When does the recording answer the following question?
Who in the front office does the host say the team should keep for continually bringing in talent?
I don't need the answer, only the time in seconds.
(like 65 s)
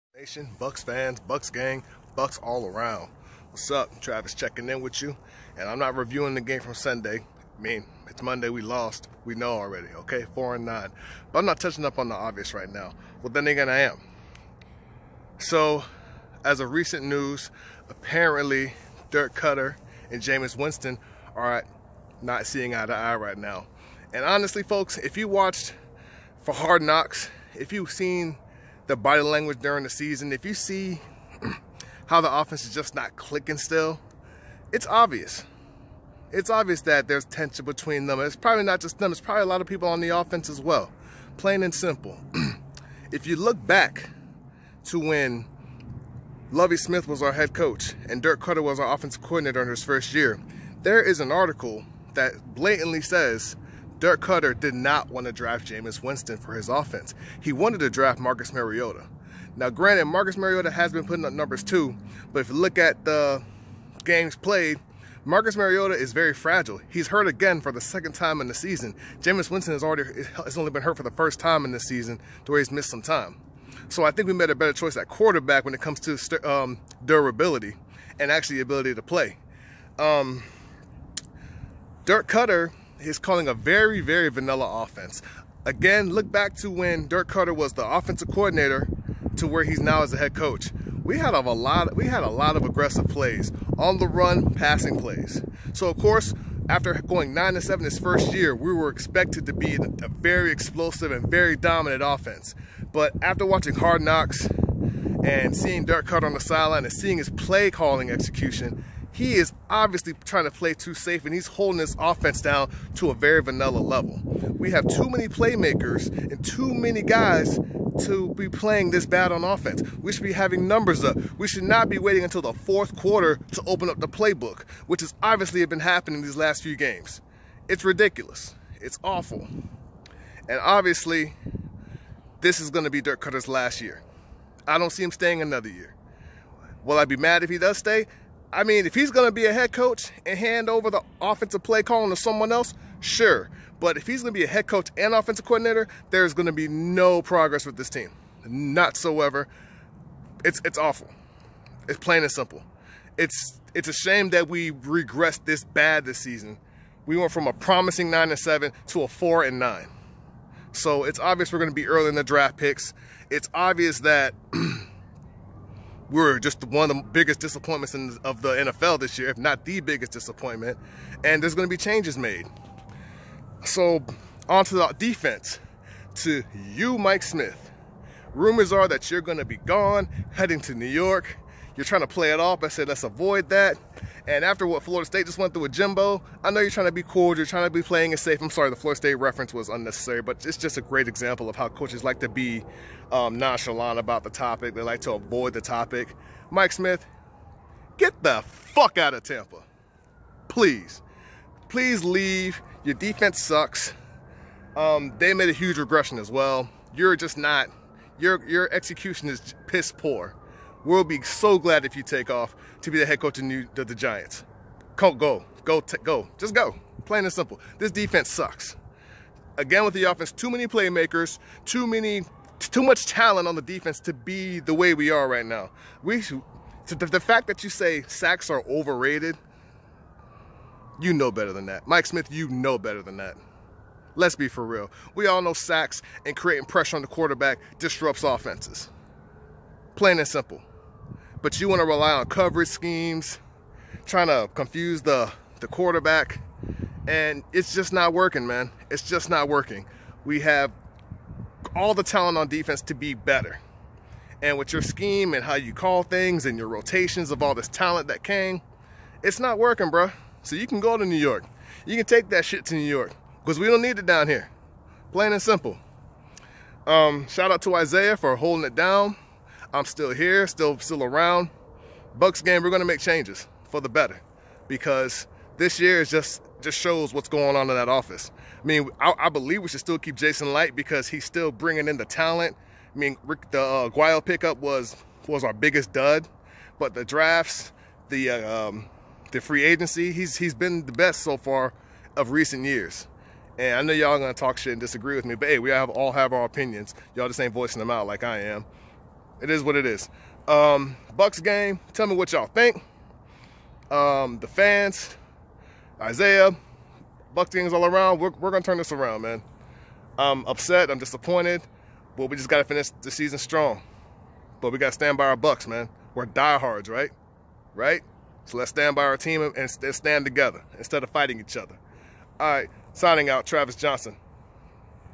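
280 s.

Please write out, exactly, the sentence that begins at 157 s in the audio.
We went from a promising nine and seven to a four and nine.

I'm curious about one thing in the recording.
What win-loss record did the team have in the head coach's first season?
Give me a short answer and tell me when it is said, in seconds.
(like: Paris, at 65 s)
9 and 7, at 97 s.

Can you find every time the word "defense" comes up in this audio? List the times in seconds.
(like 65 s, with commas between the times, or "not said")
174 s, 202 s, 217 s, 223 s, 252 s.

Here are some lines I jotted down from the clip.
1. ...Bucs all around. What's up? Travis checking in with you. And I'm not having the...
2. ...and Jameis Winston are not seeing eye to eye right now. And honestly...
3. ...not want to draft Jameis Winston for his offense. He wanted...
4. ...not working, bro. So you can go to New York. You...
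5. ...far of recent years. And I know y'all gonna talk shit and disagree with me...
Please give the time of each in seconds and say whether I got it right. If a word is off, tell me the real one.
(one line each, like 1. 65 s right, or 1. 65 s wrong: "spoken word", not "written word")
1. 2 s wrong: "reviewing", not "having"
2. 20 s right
3. 54 s right
4. 259 s right
5. 291 s right.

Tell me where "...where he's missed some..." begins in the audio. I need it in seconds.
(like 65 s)
72 s.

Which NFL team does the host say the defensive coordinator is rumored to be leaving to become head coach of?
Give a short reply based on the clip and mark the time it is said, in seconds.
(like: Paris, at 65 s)
the Giants, at 213 s.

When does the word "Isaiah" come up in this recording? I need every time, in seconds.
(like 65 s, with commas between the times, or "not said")
267 s, 305 s.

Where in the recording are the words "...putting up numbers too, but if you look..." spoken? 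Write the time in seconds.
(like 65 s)
61 s.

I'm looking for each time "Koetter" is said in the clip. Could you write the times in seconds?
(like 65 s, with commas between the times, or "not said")
19 s, 54 s, 82 s, 87 s, 106 s, 133 s.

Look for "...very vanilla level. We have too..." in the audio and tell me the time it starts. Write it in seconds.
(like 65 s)
113 s.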